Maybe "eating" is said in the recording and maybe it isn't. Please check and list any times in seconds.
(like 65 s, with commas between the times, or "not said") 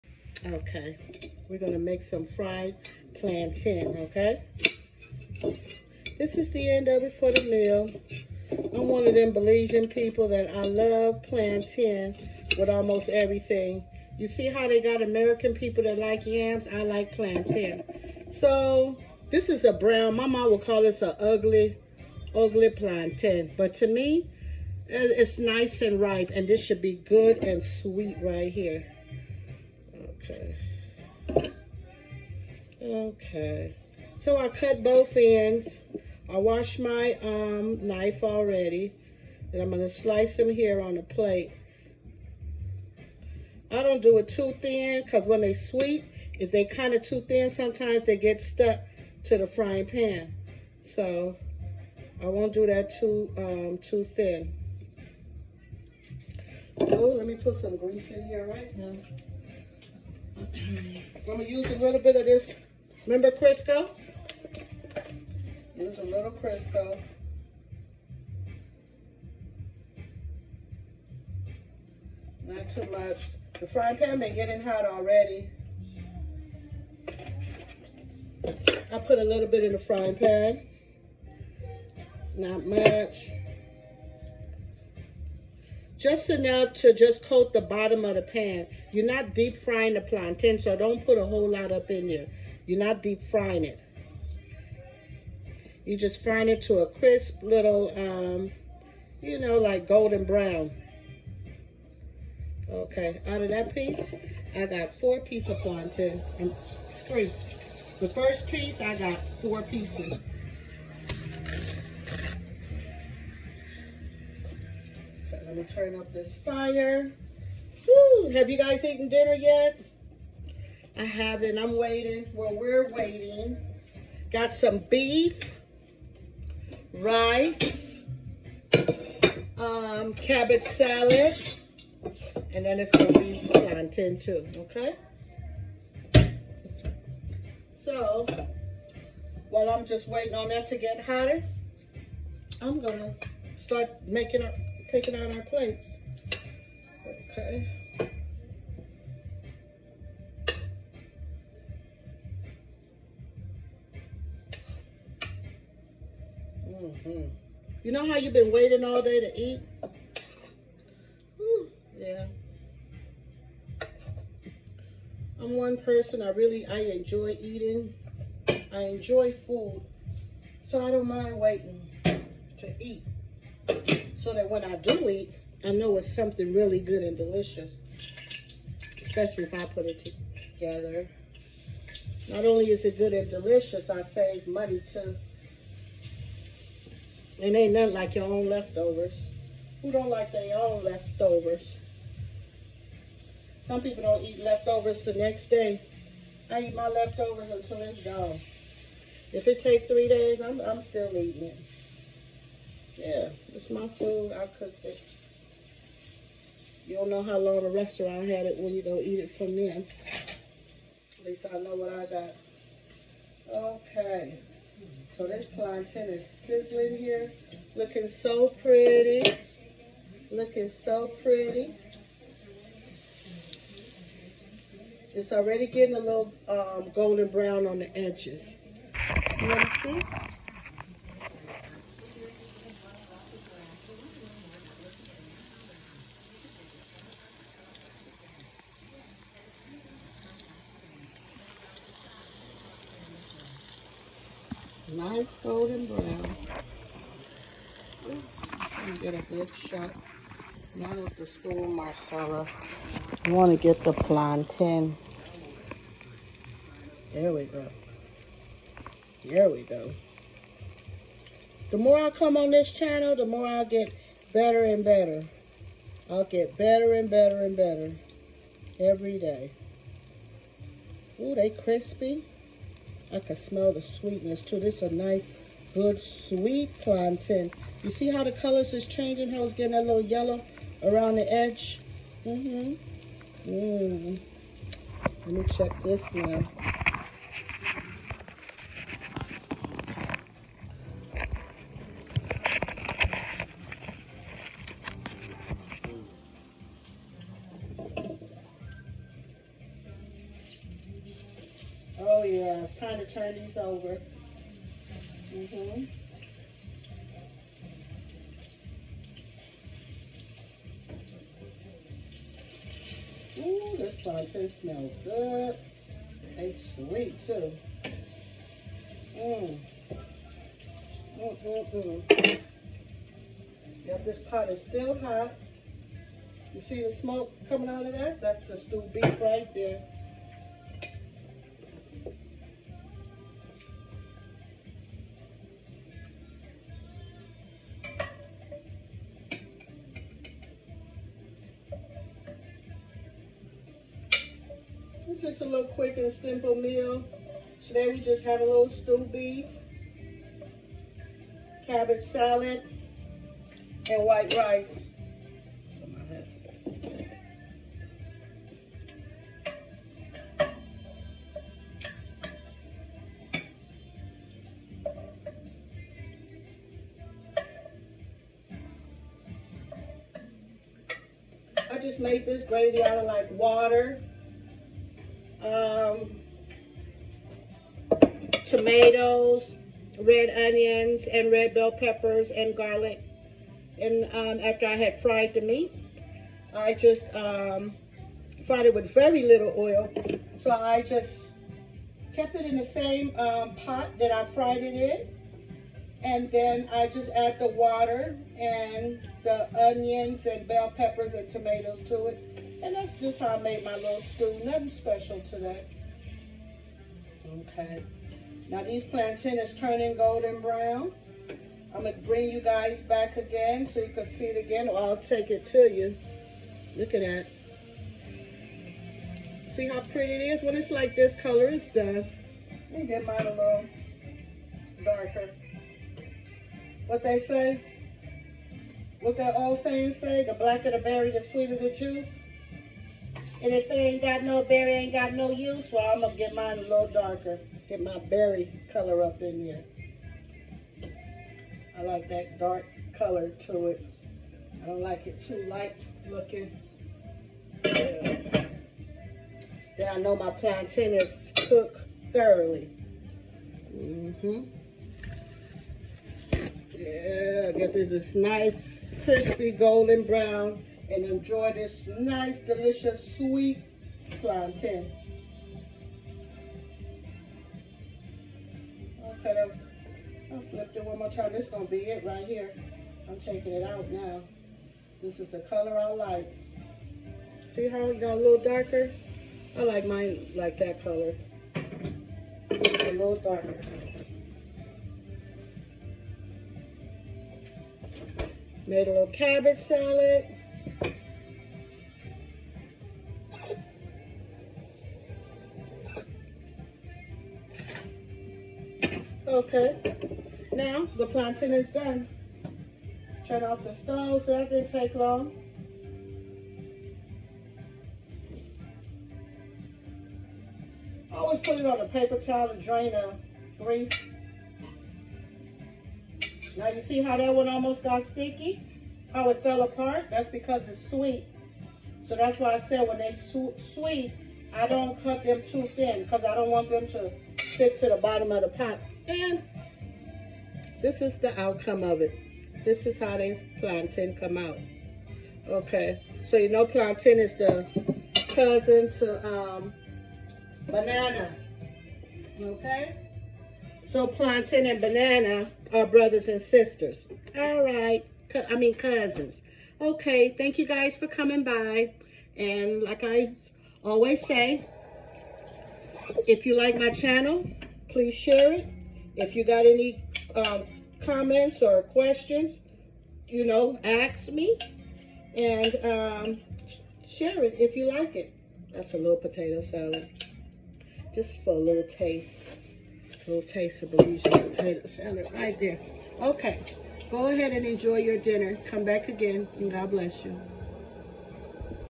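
167 s, 201 s.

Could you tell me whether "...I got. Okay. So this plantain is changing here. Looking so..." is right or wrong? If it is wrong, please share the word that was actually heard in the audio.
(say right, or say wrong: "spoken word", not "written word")
wrong: "sizzling", not "changing".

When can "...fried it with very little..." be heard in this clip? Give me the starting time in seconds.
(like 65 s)
388 s.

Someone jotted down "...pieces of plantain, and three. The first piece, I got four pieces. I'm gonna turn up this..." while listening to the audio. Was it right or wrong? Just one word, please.
right.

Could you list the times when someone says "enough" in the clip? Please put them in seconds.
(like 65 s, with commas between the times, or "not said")
86 s.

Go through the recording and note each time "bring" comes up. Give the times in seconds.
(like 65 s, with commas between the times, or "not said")
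412 s.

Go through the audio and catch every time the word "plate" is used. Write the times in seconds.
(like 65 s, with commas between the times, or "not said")
41 s, 145 s.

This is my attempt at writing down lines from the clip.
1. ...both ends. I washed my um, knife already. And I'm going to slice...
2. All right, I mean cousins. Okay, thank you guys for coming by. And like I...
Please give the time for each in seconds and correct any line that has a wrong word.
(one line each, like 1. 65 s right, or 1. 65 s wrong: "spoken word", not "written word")
1. 34 s right
2. 547 s right.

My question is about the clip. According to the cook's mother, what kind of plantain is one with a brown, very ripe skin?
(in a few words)
Ugly.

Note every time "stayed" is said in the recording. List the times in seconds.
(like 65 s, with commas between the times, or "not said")
not said.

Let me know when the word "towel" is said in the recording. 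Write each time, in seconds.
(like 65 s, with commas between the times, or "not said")
512 s.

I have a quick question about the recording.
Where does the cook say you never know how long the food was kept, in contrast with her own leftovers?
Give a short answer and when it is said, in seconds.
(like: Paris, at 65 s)
The restaurant, at 207 s.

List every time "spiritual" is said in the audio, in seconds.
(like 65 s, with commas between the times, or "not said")
not said.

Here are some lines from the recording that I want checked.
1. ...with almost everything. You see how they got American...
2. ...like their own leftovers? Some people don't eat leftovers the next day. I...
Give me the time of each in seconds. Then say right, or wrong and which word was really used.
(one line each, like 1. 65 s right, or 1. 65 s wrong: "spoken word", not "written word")
1. 12 s right
2. 190 s right.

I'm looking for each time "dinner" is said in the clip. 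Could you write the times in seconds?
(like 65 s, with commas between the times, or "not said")
119 s, 578 s.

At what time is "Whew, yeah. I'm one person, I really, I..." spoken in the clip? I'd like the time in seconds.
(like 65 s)
161 s.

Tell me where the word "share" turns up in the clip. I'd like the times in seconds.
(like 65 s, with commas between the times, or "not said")
558 s, 567 s.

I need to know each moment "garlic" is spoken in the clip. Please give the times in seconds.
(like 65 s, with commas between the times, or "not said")
382 s.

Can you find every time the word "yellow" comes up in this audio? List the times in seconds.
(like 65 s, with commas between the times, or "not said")
280 s.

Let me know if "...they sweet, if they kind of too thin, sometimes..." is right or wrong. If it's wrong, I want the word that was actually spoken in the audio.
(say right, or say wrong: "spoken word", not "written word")
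right.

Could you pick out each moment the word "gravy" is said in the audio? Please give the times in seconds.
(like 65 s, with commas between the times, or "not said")
372 s.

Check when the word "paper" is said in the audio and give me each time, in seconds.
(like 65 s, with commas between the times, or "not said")
511 s.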